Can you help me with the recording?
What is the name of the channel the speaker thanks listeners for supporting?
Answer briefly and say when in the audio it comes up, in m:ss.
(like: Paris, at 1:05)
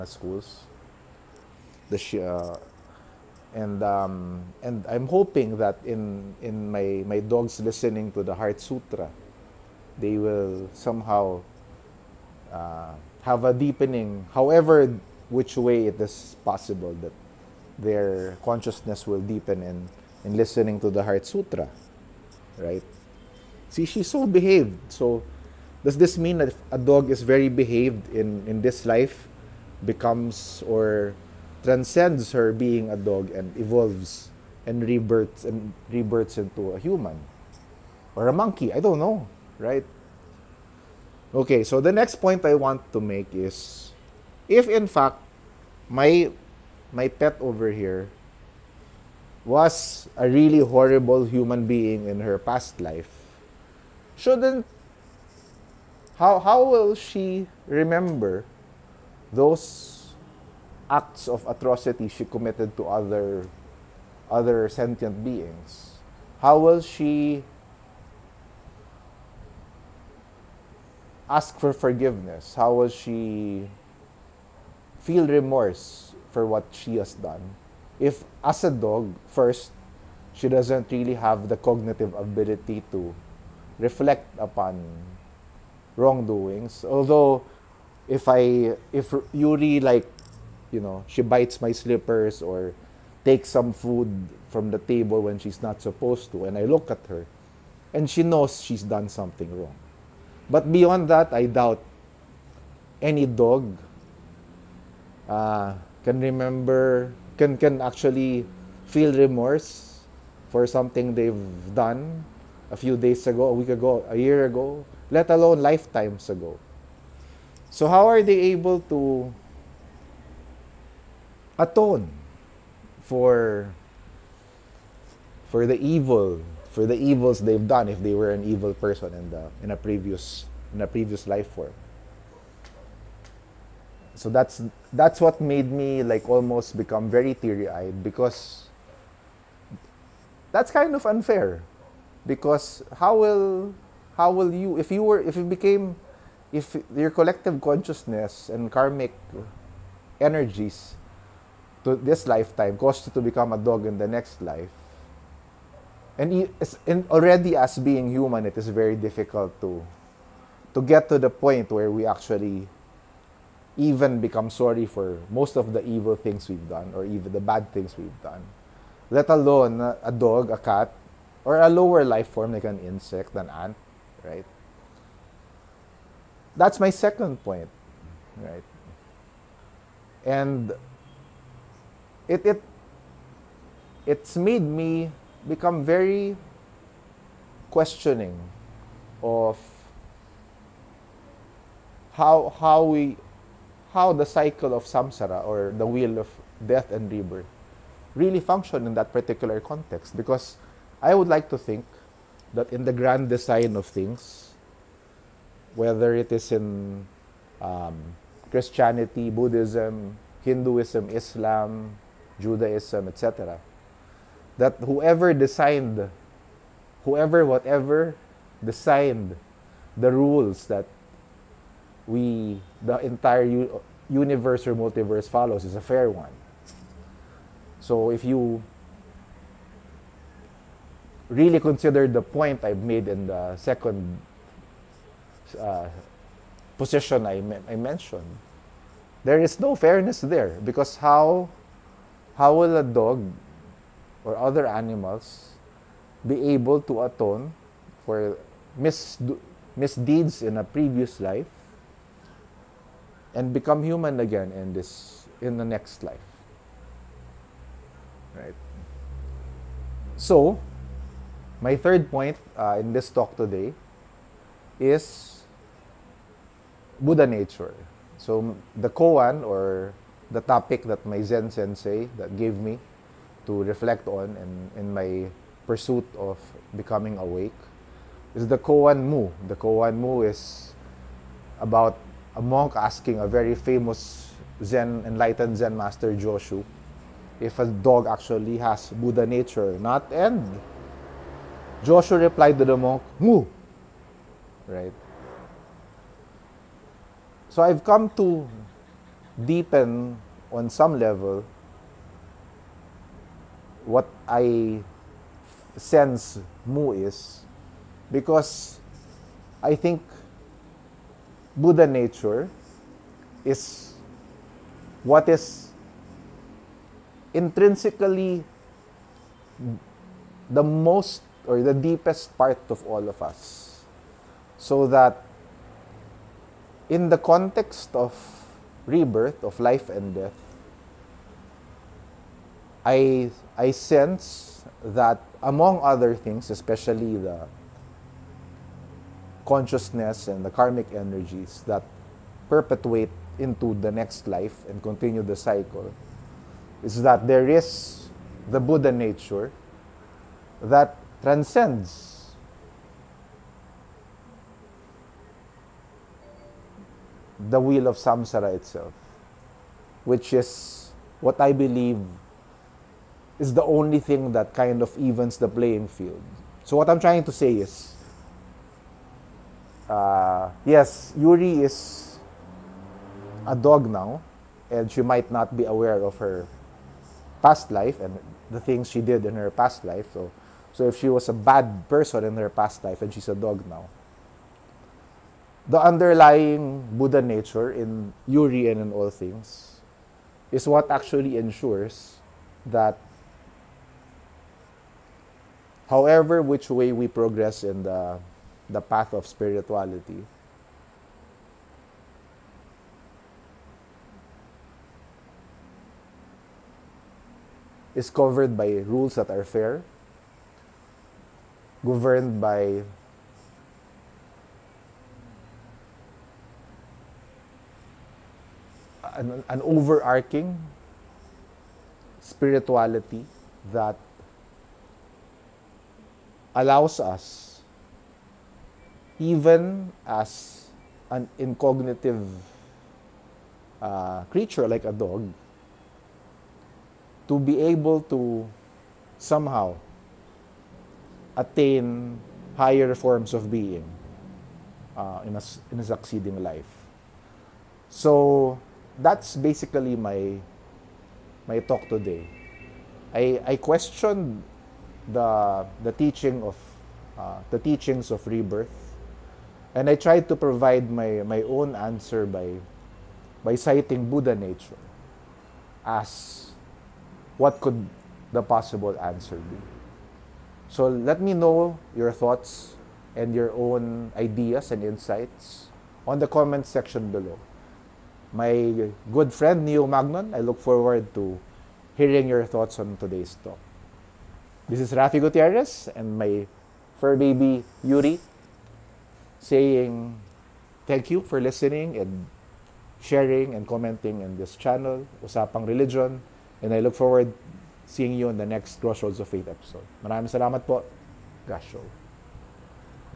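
Usapang Religion, at 8:15.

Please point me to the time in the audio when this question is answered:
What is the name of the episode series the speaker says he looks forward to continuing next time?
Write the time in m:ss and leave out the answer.
8:18.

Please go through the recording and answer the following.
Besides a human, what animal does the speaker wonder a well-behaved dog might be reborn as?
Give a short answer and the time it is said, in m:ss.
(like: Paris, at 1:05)
monkey, at 0:38.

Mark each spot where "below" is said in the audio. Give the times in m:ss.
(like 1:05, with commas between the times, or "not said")
7:57.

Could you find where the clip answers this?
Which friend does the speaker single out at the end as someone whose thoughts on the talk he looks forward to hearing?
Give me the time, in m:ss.
7:59.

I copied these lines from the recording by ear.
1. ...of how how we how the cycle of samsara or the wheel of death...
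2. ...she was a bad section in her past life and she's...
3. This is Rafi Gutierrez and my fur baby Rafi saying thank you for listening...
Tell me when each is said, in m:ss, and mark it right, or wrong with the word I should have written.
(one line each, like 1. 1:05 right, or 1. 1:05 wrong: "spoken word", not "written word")
1. 3:09 right
2. 6:20 wrong: "person", not "section"
3. 8:04 wrong: "Yuri", not "Rafi".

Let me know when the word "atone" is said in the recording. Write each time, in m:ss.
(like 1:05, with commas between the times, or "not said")
2:01, 4:07.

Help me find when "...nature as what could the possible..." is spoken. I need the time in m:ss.
7:44.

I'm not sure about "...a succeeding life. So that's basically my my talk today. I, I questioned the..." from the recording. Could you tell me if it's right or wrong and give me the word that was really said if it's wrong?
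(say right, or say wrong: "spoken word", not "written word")
right.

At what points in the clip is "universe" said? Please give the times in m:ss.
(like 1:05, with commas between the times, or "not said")
3:44.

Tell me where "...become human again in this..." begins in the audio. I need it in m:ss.
4:13.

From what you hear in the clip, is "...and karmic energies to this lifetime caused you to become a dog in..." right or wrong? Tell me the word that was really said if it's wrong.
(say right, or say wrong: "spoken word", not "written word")
right.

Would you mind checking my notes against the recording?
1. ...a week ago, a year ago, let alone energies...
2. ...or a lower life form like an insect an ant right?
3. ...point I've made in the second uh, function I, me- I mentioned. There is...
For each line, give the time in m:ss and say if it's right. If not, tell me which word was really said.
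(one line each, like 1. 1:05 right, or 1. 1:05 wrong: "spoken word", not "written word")
1. 1:53 wrong: "lifetimes", not "energies"
2. 2:51 right
3. 3:52 wrong: "position", not "function".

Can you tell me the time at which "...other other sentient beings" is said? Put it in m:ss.
1:02.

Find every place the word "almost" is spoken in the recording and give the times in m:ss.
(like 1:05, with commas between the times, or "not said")
2:16.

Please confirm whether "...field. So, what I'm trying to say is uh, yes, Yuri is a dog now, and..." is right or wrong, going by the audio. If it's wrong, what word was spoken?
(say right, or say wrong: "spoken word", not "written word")
right.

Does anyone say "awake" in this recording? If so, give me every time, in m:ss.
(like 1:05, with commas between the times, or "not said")
4:37.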